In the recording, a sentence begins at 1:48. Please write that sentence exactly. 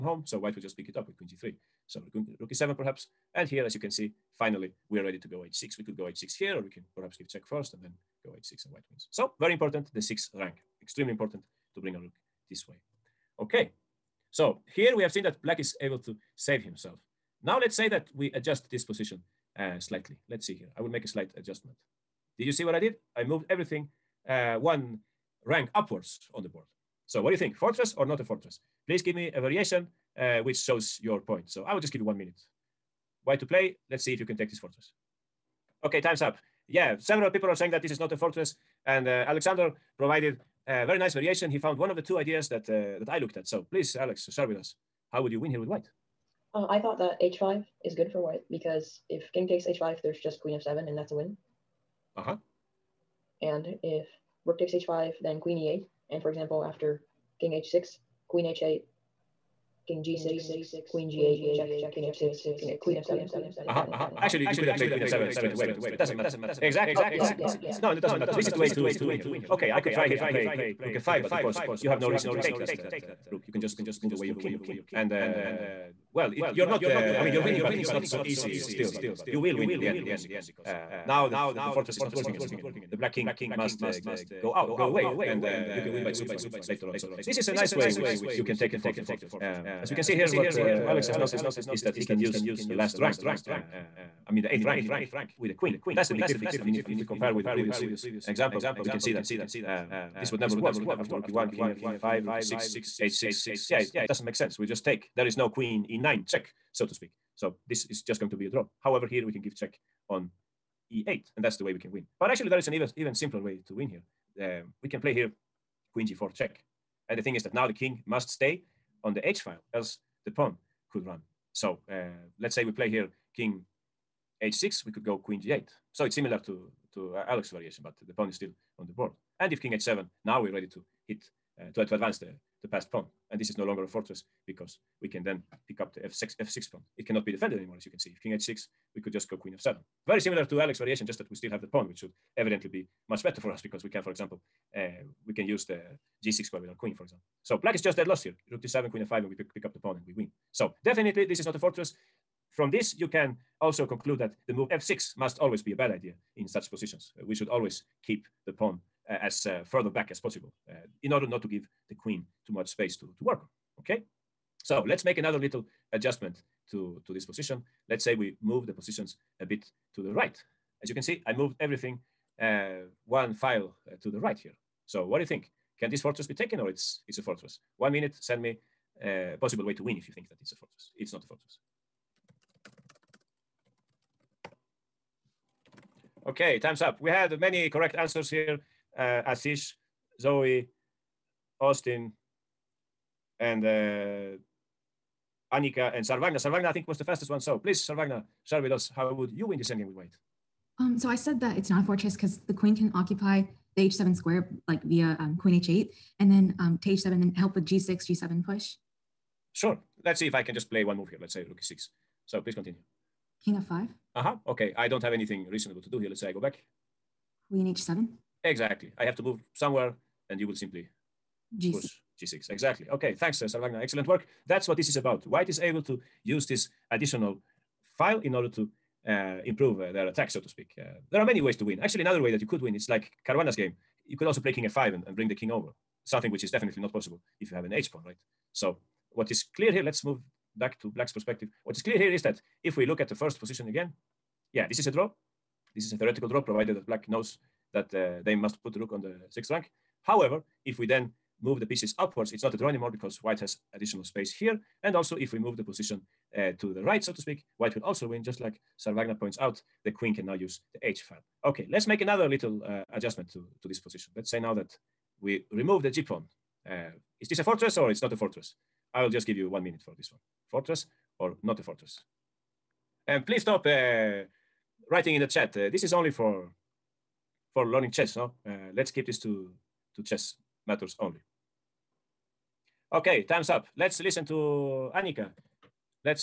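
However, here we can give check on e8, and that's the way we can win.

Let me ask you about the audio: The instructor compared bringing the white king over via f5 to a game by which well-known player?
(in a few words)
Caruana.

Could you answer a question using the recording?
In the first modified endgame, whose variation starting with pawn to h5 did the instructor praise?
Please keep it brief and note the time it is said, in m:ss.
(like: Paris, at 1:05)
Alexander, at 0:39.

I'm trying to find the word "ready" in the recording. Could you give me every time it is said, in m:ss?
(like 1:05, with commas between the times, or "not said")
0:05, 2:10.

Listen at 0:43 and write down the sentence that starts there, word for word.
So please, Alex, share with us.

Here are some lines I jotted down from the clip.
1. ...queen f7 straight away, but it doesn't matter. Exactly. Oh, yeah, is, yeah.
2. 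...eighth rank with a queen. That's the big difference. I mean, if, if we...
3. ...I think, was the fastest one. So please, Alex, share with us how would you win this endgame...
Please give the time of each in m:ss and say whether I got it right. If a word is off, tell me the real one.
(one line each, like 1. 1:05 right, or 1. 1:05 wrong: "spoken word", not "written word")
1. 1:04 right
2. 1:34 right
3. 3:16 wrong: "Sarvagna", not "Alex".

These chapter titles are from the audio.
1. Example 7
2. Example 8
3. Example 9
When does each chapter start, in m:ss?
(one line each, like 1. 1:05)
1. 0:25
2. 2:52
3. 4:26.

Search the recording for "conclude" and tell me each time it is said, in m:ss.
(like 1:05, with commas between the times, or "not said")
2:33.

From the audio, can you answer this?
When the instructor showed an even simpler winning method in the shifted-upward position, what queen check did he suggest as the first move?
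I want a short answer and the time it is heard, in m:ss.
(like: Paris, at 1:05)
Queen g4 check, at 1:55.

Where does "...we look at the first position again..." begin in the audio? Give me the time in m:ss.
4:02.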